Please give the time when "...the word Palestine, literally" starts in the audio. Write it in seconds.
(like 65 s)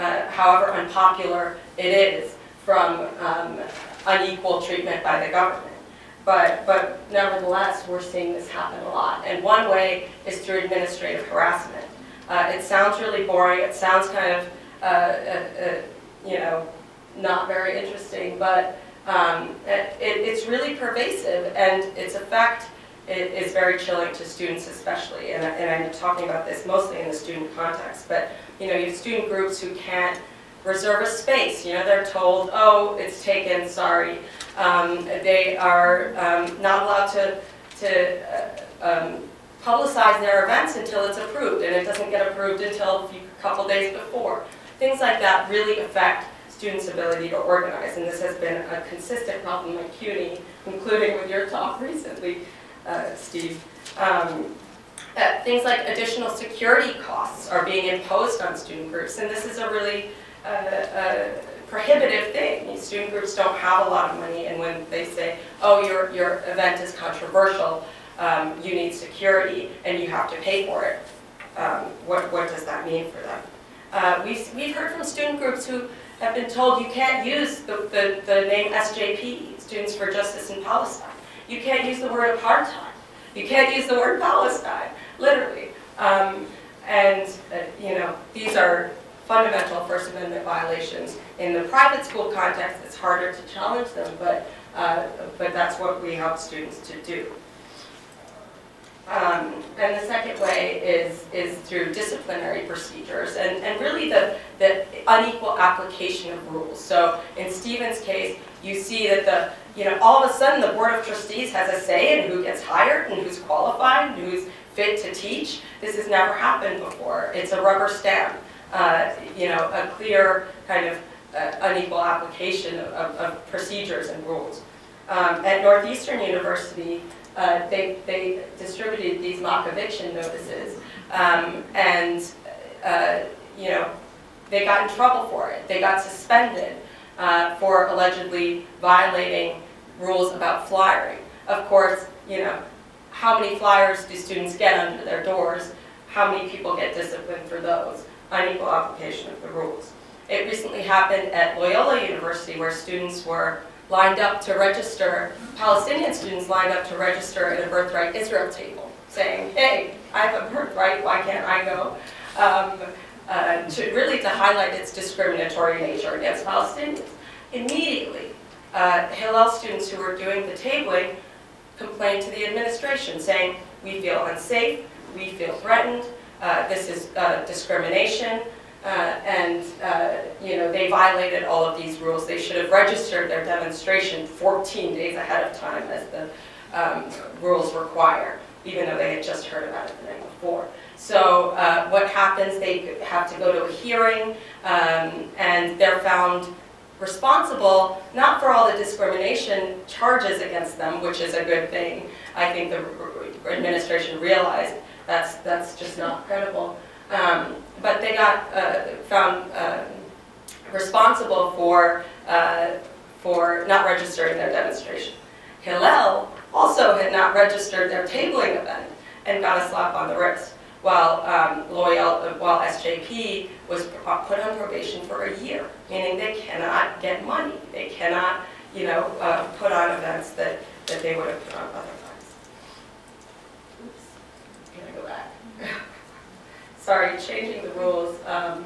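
83 s.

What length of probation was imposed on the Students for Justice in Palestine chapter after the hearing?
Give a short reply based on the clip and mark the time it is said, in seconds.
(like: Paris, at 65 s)
a year, at 225 s.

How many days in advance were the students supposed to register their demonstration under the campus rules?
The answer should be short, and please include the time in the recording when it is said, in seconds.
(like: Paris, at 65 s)
14 days, at 184 s.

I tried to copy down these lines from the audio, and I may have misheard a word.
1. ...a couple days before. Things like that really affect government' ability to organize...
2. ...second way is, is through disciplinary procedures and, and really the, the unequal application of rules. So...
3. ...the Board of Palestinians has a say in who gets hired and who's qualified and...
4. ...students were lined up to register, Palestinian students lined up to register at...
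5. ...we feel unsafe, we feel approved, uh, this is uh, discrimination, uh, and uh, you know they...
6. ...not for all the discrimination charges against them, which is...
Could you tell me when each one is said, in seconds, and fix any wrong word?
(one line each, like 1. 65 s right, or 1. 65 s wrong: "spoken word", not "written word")
1. 43 s wrong: "students", not "government"
2. 100 s right
3. 110 s wrong: "Trustees", not "Palestinians"
4. 152 s right
5. 173 s wrong: "threatened", not "approved"
6. 198 s right.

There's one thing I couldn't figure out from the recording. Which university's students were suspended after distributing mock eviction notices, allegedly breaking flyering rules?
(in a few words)
Northeastern University.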